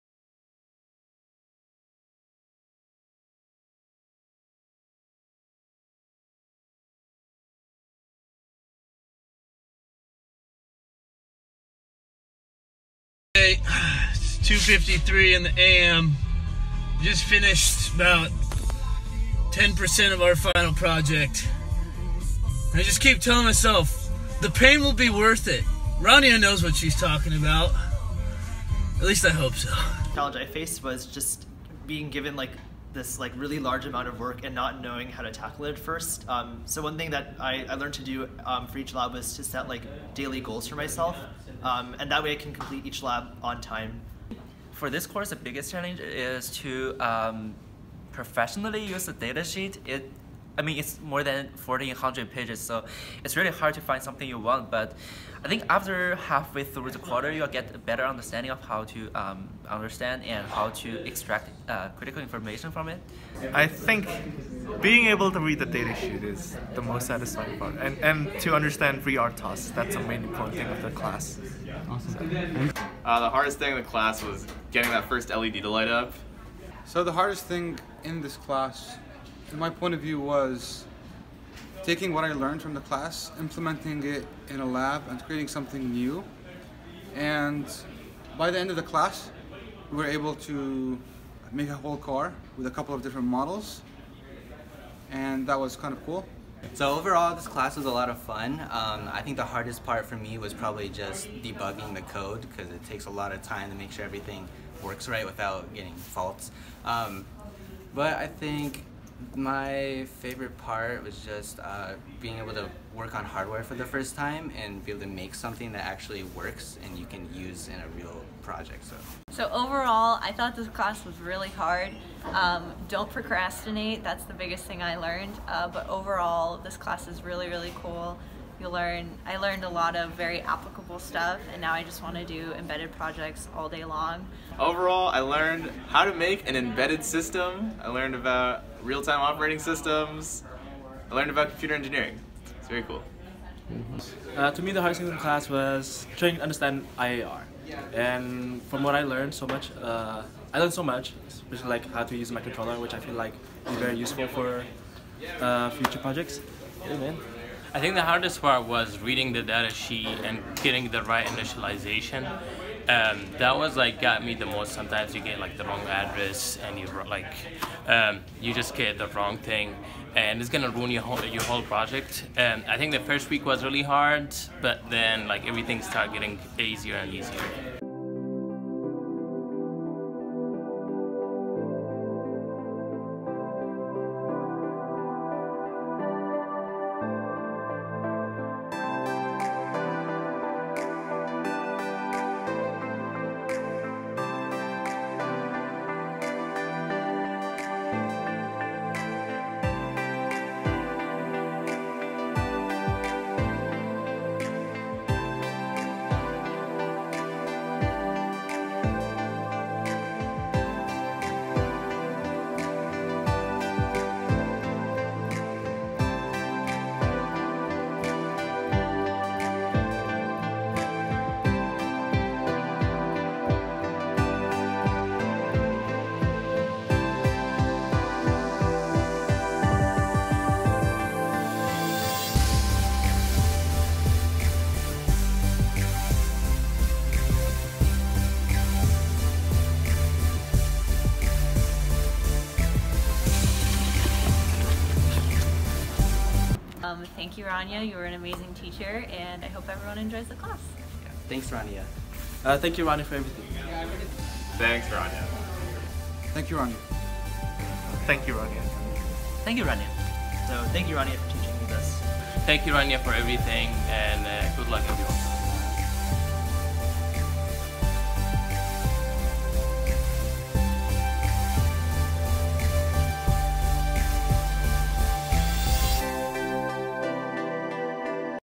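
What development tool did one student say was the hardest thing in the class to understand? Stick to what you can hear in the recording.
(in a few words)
IAR.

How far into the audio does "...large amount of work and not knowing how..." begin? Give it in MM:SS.
00:33.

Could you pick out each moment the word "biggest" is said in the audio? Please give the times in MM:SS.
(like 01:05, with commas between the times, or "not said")
00:45, 02:04.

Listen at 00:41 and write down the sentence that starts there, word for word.
Um, and that way I can complete each lab on time.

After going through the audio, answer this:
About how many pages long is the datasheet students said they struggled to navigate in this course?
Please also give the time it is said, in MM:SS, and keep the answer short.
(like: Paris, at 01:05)
1400, at 00:51.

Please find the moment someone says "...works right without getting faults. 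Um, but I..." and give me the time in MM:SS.
01:44.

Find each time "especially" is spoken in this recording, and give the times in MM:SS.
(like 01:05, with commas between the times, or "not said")
02:31.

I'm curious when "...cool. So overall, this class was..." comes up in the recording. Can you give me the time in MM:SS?
01:36.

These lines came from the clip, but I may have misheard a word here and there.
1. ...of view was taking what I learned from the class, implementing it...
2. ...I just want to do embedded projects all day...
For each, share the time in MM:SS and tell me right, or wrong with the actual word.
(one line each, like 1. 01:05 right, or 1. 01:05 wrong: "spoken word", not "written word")
1. 01:19 right
2. 02:11 right.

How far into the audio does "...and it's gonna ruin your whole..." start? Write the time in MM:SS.
02:50.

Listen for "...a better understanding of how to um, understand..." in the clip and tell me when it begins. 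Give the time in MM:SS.
00:57.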